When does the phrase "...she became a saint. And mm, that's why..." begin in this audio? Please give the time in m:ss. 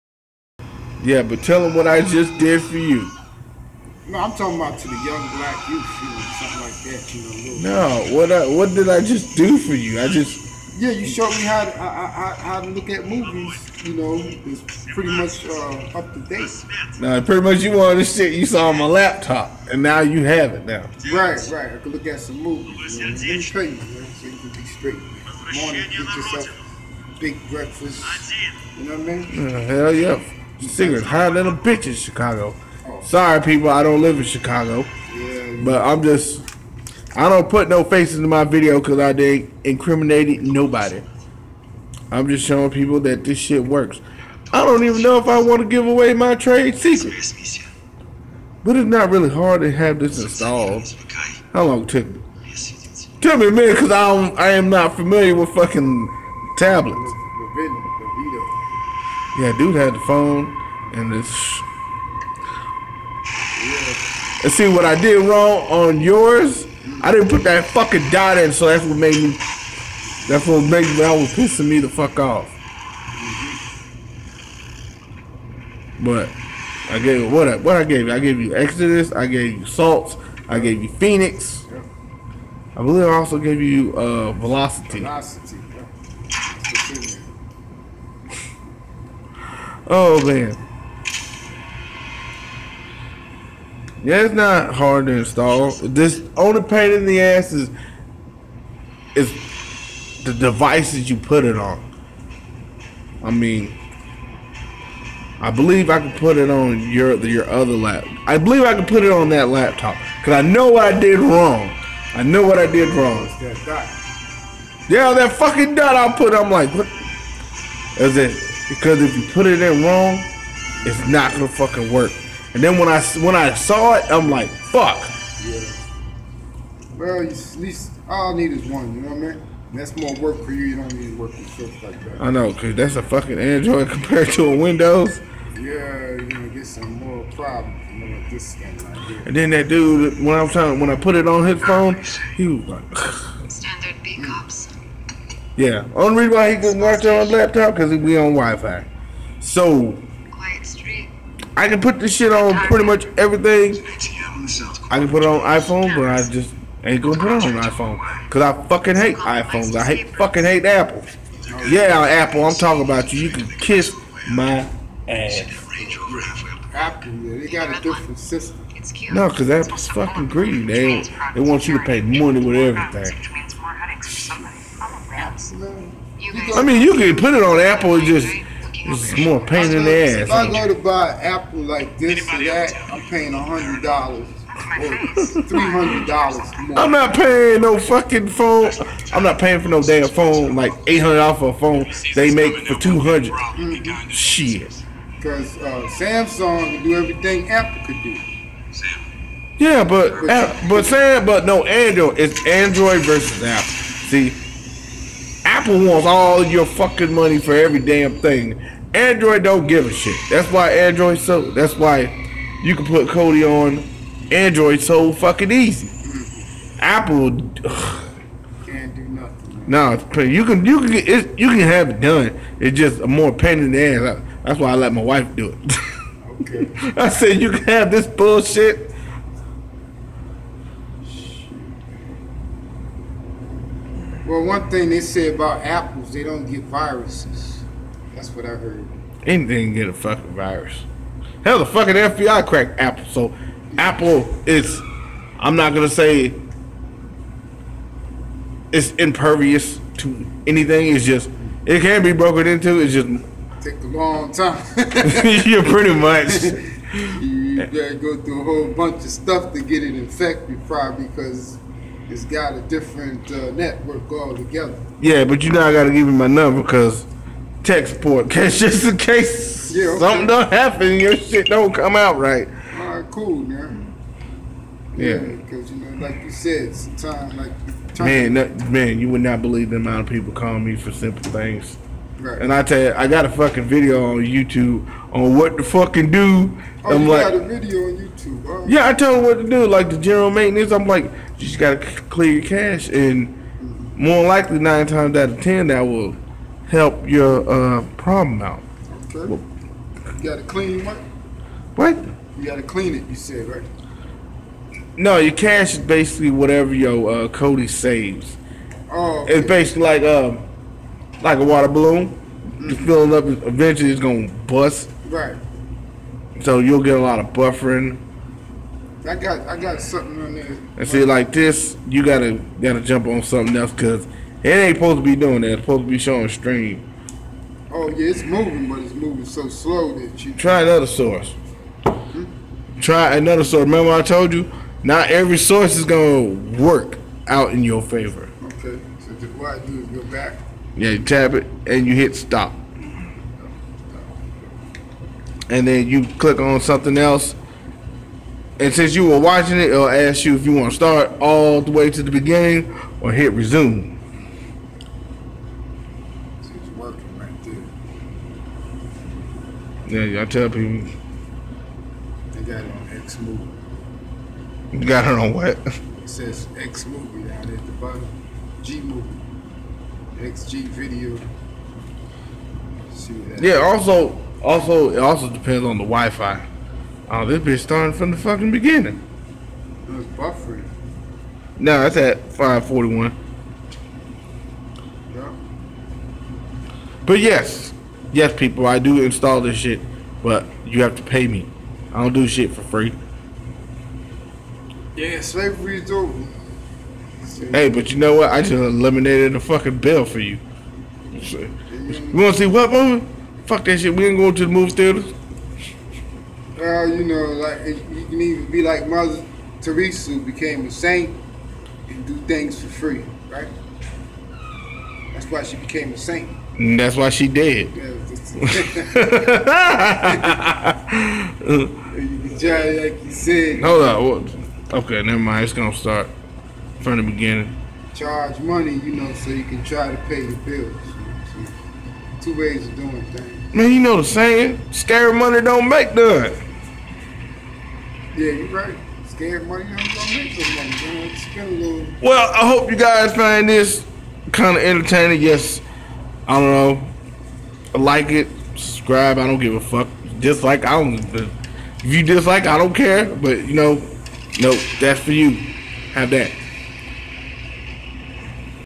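6:55.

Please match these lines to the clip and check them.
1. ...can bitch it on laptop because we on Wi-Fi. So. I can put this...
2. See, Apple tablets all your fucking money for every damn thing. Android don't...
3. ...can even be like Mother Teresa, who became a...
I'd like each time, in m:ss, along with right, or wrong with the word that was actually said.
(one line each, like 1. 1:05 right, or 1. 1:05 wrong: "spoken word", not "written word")
1. 2:26 wrong: "watch", not "bitch"
2. 3:23 wrong: "wants", not "tablets"
3. 6:48 right.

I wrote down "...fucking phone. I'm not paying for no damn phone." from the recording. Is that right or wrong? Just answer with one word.
right.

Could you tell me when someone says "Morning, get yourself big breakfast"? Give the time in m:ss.
0:24.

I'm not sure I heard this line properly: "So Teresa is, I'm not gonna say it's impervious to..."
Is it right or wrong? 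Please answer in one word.
wrong.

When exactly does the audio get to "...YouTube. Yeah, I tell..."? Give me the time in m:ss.
4:47.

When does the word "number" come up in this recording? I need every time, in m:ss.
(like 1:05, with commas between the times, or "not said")
4:26.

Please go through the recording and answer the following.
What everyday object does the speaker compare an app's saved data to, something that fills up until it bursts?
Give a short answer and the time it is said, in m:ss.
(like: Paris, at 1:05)
water balloon, at 5:11.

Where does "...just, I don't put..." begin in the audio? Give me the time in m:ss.
0:36.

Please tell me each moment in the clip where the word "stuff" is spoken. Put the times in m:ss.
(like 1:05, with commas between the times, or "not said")
2:11, 4:19.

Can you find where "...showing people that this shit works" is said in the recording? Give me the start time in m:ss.
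0:42.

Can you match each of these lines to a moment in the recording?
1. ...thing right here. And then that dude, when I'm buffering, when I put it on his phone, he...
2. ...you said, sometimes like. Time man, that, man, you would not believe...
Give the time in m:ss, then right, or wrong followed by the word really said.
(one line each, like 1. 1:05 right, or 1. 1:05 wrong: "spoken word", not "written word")
1. 2:18 wrong: "trying", not "buffering"
2. 4:36 right.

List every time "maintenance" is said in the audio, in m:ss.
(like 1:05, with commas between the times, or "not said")
4:50.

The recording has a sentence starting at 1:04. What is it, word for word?
And see what I did wrong on yours.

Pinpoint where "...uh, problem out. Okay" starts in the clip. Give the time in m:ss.
4:57.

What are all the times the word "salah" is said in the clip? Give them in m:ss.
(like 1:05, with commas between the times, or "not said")
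not said.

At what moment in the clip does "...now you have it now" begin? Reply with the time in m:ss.
0:19.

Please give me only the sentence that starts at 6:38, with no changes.
I just eliminated the fucking bill for you.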